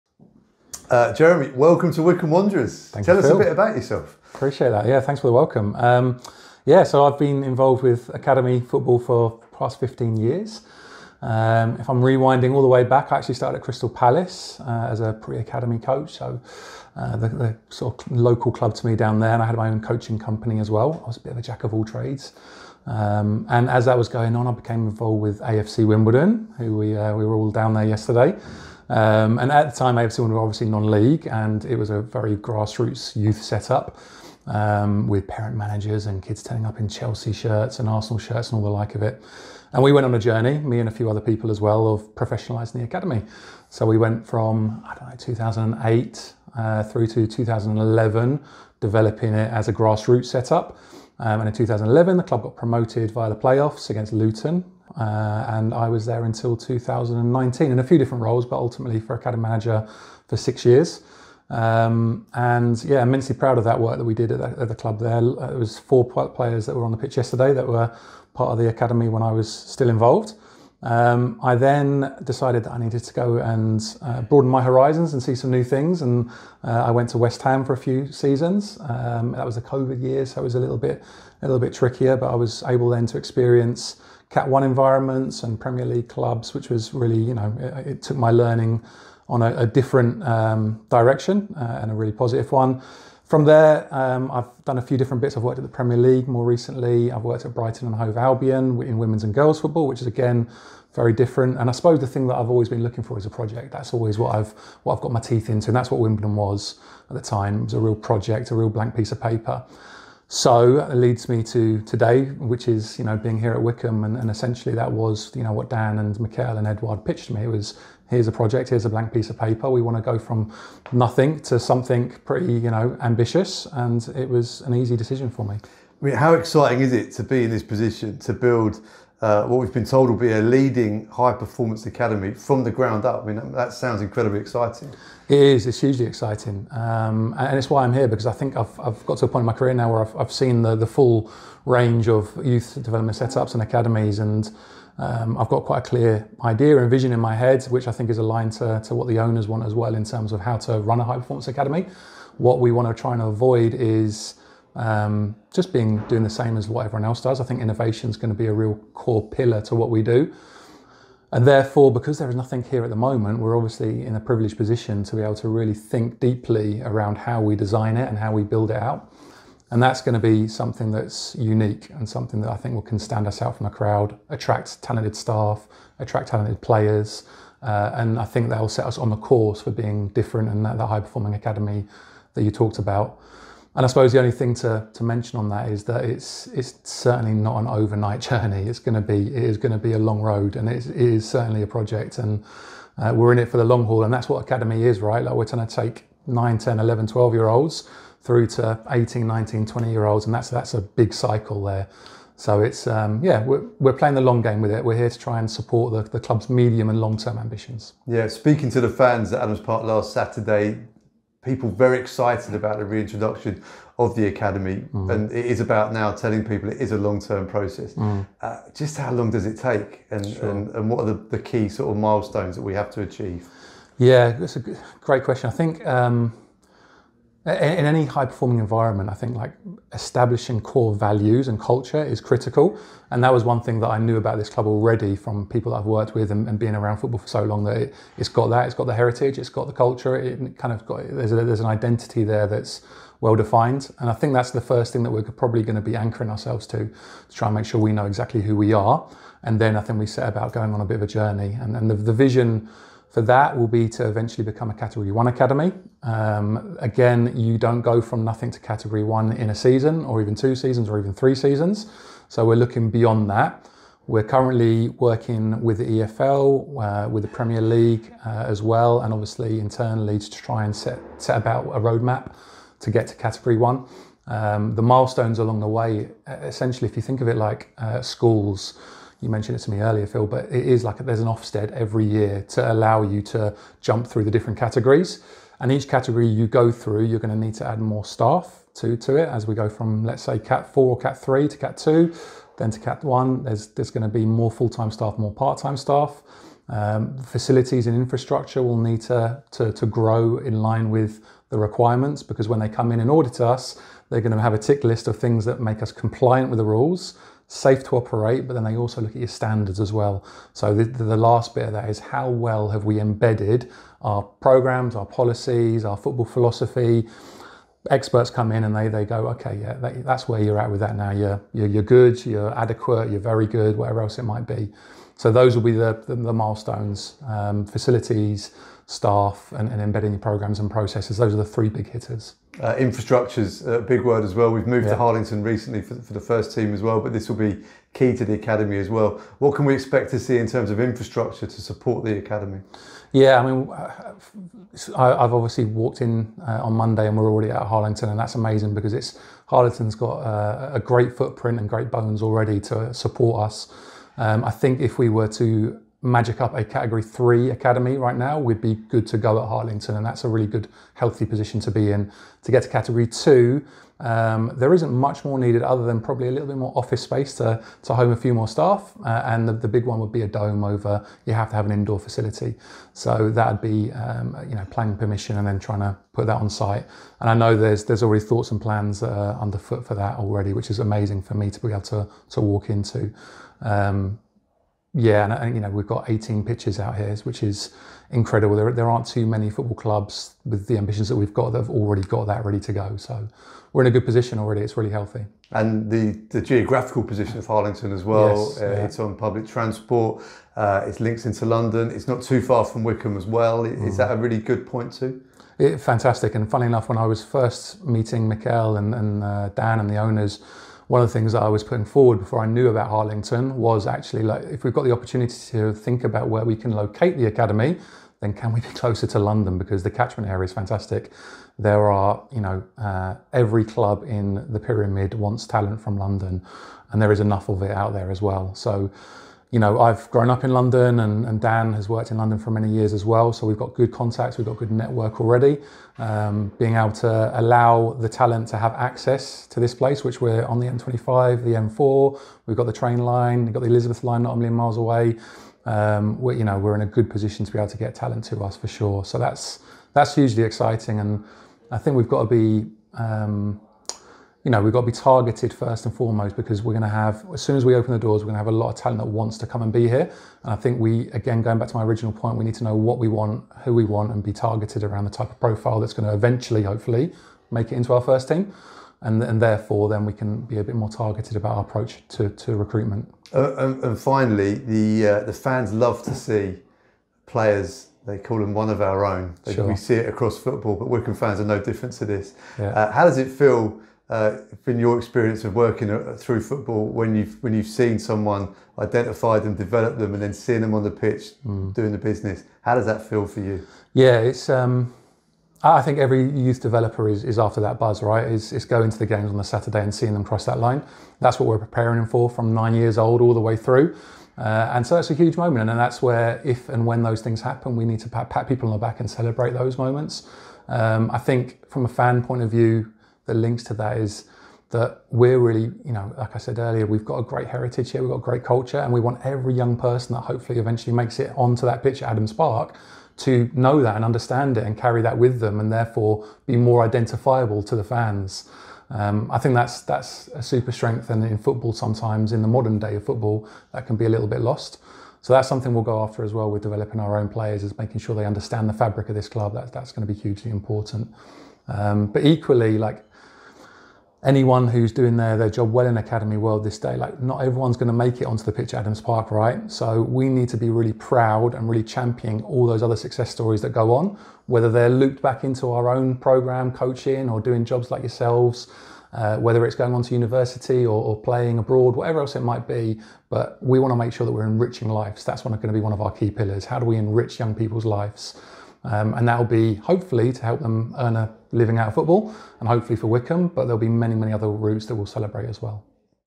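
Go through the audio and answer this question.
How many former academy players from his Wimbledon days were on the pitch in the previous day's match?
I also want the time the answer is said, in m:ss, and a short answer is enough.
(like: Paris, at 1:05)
4, at 1:05.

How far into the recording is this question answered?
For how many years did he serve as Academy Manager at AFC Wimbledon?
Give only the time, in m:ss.
1:00.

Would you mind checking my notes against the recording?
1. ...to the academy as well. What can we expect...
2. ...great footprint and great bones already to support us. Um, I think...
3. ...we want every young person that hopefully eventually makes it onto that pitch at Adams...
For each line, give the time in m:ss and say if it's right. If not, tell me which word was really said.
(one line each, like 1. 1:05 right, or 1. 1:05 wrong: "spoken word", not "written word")
1. 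5:38 right
2. 5:50 right
3. 8:38 right.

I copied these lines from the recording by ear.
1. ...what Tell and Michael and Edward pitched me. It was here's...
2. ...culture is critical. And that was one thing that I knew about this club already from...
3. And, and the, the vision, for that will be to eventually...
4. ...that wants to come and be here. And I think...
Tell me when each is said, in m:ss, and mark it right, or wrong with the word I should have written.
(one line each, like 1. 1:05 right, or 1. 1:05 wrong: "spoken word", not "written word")
1. 1:55 wrong: "Dan", not "Tell"
2. 3:51 right
3. 4:11 right
4. 7:38 right.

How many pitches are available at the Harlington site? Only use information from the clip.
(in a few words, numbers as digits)
18.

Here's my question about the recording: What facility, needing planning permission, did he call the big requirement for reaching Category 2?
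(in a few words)
A dome.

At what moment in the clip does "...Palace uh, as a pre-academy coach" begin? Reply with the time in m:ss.
0:13.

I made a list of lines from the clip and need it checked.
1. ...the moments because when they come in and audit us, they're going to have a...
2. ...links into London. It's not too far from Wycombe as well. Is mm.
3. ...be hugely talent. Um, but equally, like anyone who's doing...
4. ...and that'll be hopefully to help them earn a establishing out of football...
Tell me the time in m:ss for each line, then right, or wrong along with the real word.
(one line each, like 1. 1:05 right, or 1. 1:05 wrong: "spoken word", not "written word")
1. 5:01 wrong: "requirements", not "moments"
2. 6:40 right
3. 9:00 wrong: "important", not "talent"
4. 9:29 wrong: "living", not "establishing".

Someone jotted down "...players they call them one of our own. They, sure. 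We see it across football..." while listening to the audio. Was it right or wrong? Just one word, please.
right.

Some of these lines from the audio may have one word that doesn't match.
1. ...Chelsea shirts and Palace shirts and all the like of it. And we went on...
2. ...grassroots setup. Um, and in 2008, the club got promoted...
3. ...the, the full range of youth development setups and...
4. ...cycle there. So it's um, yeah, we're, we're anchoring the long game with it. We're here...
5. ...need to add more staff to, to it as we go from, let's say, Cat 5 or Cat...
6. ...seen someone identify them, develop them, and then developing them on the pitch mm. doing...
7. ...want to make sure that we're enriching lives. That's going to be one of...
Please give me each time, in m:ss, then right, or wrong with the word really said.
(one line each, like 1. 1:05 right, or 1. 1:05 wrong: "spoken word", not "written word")
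1. 0:36 wrong: "Arsenal", not "Palace"
2. 0:49 wrong: "2011", not "2008"
3. 2:20 right
4. 3:21 wrong: "playing", not "anchoring"
5. 4:47 wrong: "4", not "5"
6. 8:07 wrong: "seeing", not "developing"
7. 9:23 right.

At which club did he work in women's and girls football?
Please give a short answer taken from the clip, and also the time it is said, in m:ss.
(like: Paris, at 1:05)
Brighton and Hove Albion, at 1:37.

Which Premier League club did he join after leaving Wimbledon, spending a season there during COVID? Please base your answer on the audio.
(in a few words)
West Ham.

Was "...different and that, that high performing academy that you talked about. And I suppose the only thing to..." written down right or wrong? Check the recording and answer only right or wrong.
right.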